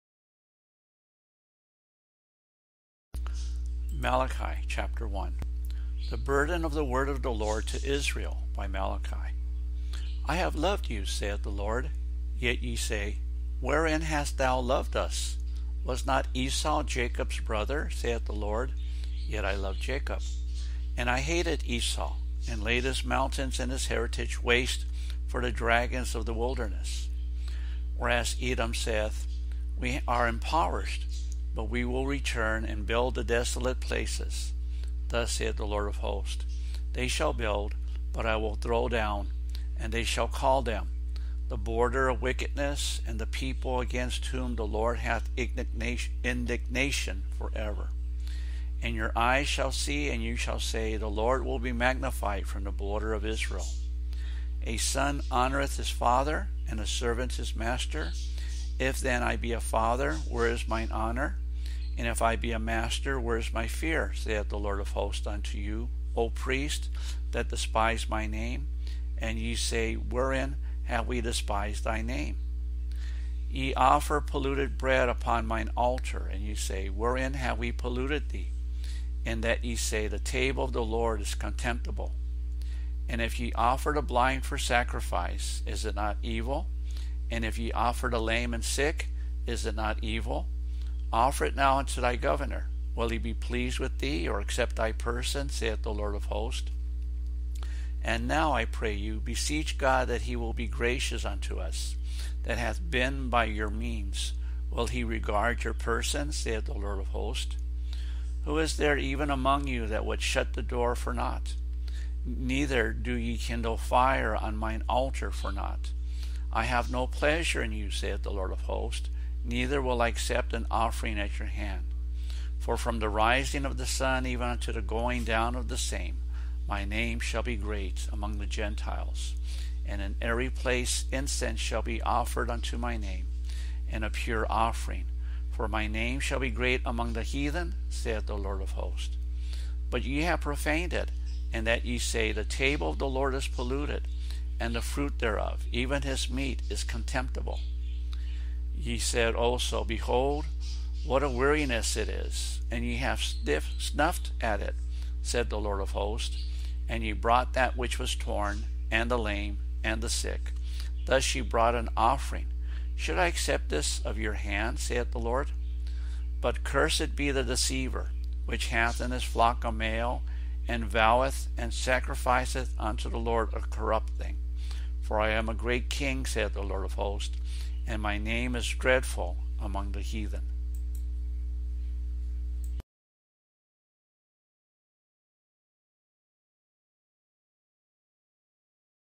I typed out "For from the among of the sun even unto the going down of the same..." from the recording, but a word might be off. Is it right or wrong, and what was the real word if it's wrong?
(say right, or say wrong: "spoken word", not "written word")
wrong: "rising", not "among".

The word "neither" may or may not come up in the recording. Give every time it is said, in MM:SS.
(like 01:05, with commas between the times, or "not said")
01:52, 01:59.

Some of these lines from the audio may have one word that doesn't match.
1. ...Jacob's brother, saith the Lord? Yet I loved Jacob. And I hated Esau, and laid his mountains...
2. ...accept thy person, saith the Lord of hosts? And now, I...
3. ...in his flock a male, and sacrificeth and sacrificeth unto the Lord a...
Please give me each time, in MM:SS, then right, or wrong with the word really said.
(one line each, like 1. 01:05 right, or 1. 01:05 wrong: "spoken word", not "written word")
1. 00:16 right
2. 01:34 right
3. 02:48 wrong: "voweth", not "sacrificeth".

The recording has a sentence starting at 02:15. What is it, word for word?
For my name shall be great among the heathen, saith the Lord of hosts.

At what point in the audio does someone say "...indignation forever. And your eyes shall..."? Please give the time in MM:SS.
00:45.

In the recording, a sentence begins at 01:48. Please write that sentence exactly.
Who is there even among you that would shut the door for naught?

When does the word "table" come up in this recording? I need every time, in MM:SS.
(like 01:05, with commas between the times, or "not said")
01:20, 02:22.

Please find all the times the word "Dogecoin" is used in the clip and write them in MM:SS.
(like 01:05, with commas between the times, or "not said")
not said.